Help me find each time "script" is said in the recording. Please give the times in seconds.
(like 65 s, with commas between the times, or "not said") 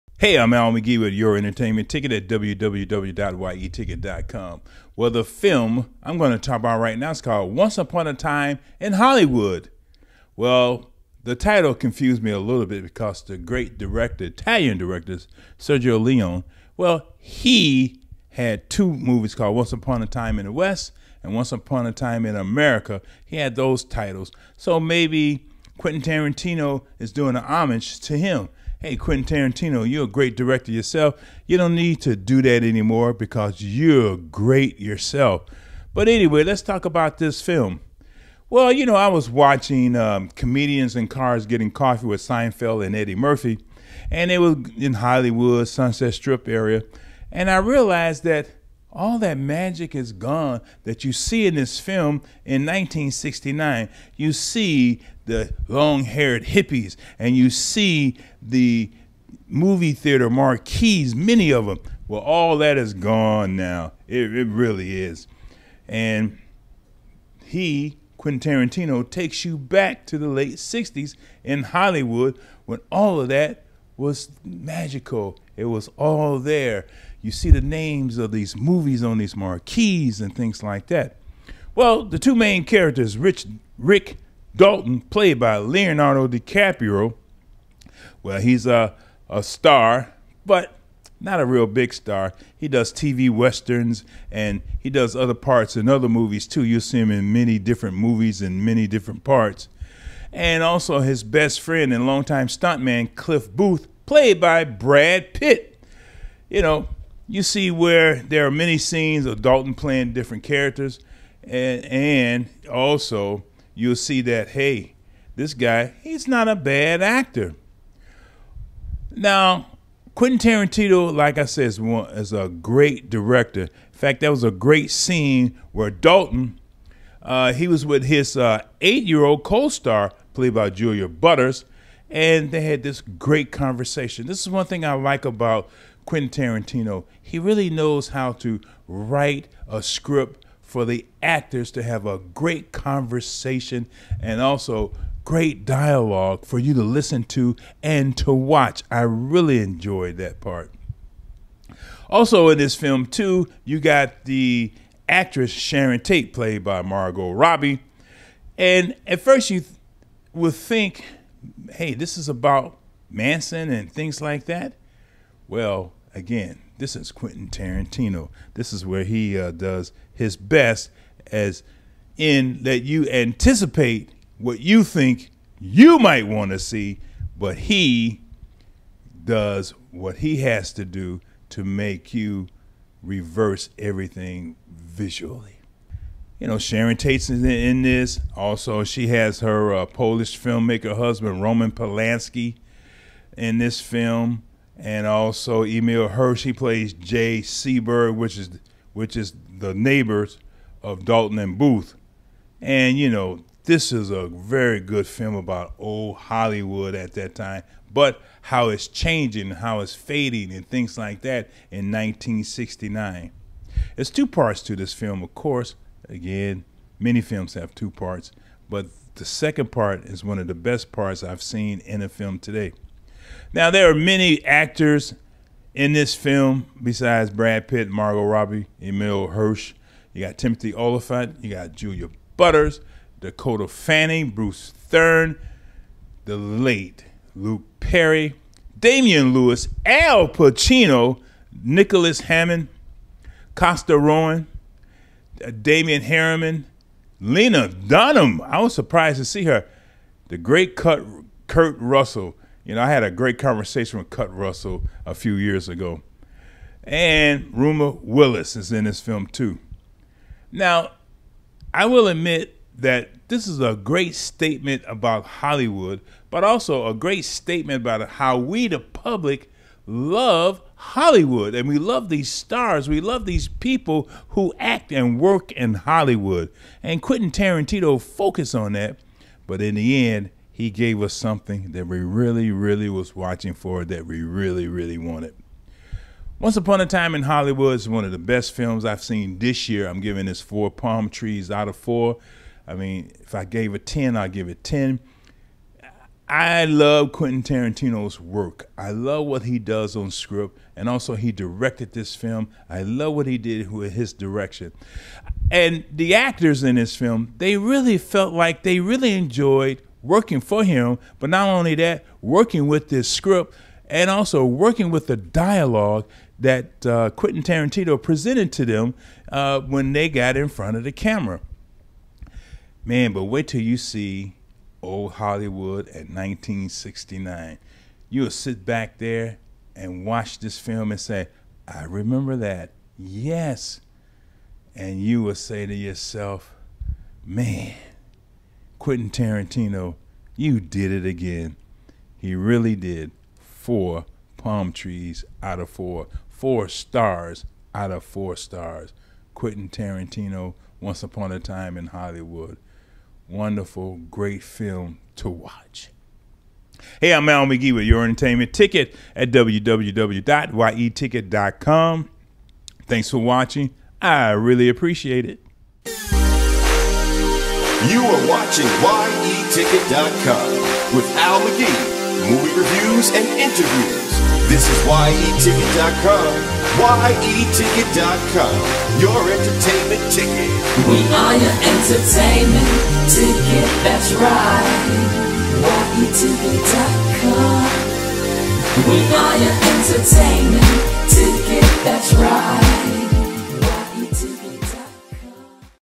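139 s, 300 s, 313 s.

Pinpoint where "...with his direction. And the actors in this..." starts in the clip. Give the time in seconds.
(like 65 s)
303 s.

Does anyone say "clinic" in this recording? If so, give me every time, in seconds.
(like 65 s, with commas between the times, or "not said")
not said.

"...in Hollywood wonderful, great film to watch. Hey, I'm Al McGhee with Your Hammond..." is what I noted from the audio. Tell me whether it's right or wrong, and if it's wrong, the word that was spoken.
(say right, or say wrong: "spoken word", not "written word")
wrong: "Entertainment", not "Hammond".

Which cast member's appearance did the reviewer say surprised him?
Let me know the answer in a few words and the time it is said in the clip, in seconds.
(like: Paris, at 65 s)
Lena Dunham, at 247 s.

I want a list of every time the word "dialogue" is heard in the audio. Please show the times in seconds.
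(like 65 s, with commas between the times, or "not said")
145 s, 315 s.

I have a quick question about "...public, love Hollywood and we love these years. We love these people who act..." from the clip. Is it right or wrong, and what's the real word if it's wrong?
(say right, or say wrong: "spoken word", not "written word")
wrong: "stars", not "years".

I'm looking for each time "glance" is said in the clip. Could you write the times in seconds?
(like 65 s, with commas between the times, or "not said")
not said.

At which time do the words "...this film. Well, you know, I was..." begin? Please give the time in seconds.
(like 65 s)
37 s.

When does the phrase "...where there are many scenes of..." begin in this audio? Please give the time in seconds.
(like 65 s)
107 s.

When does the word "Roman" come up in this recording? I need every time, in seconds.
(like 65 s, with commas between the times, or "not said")
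191 s.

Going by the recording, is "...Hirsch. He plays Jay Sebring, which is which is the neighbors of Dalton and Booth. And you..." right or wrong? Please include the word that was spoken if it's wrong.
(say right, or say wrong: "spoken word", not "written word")
right.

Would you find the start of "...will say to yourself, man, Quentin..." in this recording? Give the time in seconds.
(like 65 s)
335 s.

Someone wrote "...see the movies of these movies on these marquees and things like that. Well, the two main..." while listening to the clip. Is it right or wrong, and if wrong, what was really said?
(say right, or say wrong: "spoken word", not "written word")
wrong: "names", not "movies".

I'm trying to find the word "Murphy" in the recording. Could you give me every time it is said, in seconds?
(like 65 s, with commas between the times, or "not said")
43 s.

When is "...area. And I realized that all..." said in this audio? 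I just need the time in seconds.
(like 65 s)
46 s.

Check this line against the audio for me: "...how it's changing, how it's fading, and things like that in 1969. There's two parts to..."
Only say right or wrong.
right.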